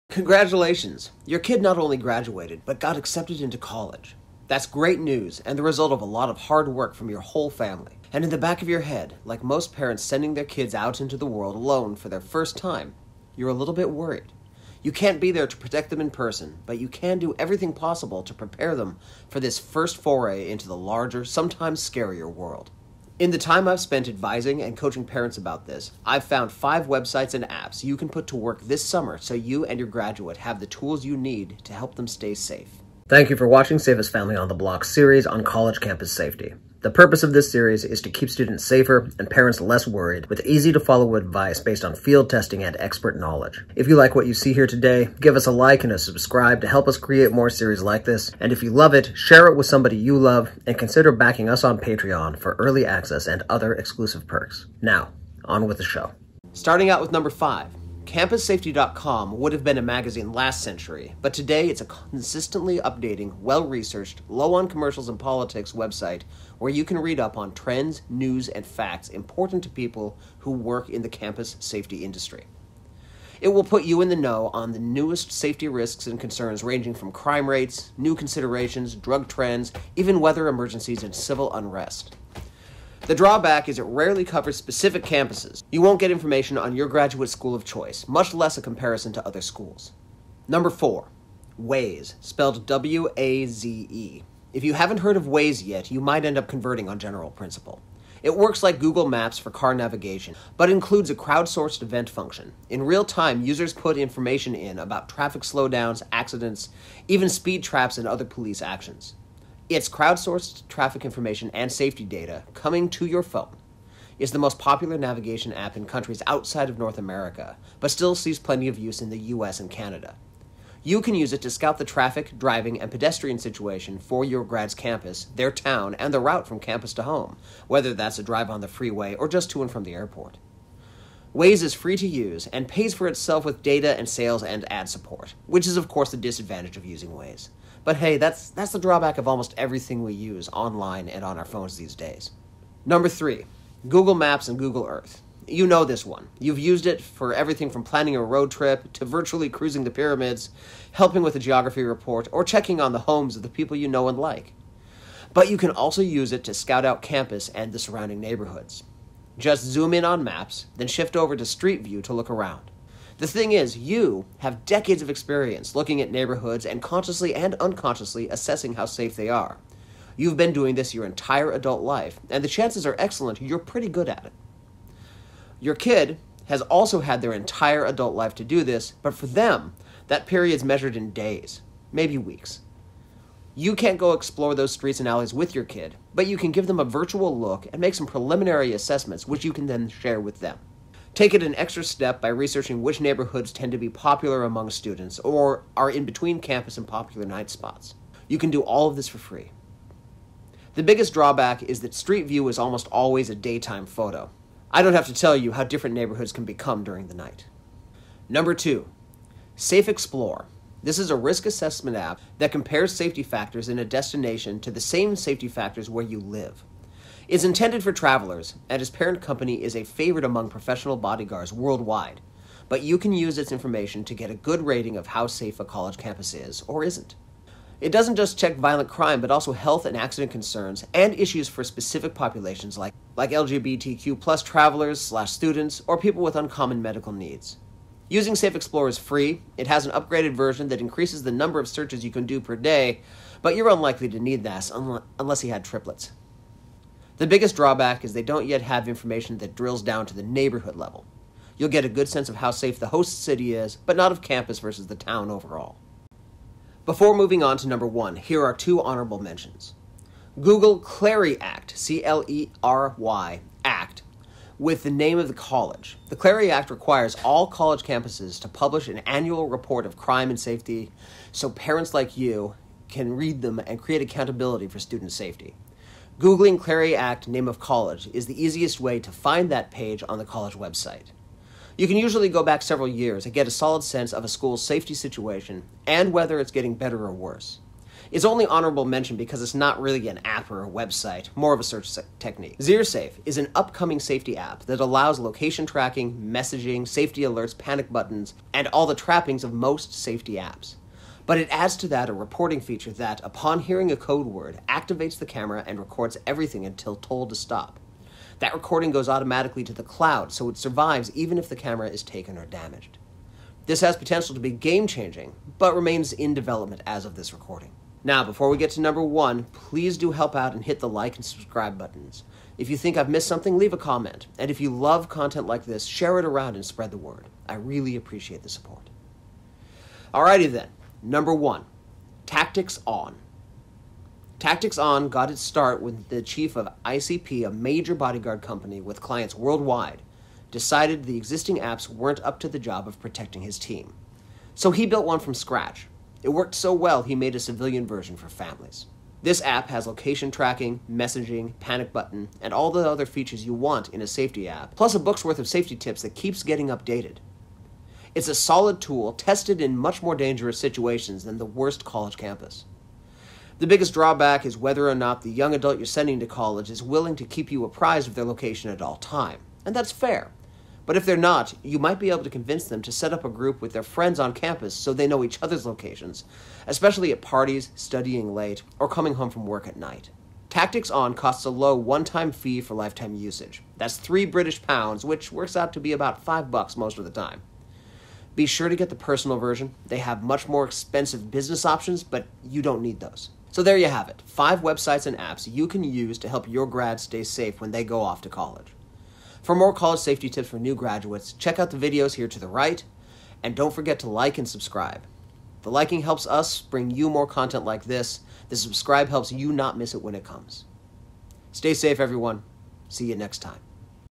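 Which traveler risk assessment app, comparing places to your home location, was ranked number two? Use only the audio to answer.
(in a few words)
Safe Explore.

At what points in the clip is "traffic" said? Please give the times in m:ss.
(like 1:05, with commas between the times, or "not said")
1:45, 1:50, 2:01.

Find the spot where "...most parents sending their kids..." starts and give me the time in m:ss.
0:09.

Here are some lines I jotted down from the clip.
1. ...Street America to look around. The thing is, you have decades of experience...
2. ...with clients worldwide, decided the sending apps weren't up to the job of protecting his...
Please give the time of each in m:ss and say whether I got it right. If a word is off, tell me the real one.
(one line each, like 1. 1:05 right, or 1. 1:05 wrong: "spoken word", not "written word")
1. 2:41 wrong: "View", not "America"
2. 5:38 wrong: "existing", not "sending".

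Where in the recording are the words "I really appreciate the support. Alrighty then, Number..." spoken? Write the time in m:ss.
5:27.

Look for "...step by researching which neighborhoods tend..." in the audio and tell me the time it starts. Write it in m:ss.
3:11.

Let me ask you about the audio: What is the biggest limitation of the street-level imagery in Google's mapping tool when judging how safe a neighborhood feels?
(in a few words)
Daytime photo.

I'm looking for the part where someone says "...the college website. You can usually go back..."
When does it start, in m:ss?
4:40.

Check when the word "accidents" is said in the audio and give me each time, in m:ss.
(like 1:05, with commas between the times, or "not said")
1:46, 3:49.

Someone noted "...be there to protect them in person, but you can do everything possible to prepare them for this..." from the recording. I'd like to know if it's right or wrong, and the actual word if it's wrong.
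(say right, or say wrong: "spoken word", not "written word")
right.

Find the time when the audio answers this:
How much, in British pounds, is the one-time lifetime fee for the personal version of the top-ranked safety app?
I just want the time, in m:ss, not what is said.
6:23.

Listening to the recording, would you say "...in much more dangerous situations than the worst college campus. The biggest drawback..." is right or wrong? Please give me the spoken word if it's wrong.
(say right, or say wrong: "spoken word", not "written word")
right.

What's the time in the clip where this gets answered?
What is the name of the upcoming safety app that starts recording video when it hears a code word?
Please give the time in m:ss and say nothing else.
4:52.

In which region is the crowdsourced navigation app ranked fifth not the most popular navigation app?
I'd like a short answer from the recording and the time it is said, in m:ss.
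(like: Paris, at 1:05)
North America, at 1:56.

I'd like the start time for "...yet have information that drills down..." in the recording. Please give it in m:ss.
4:08.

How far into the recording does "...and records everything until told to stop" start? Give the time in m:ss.
5:05.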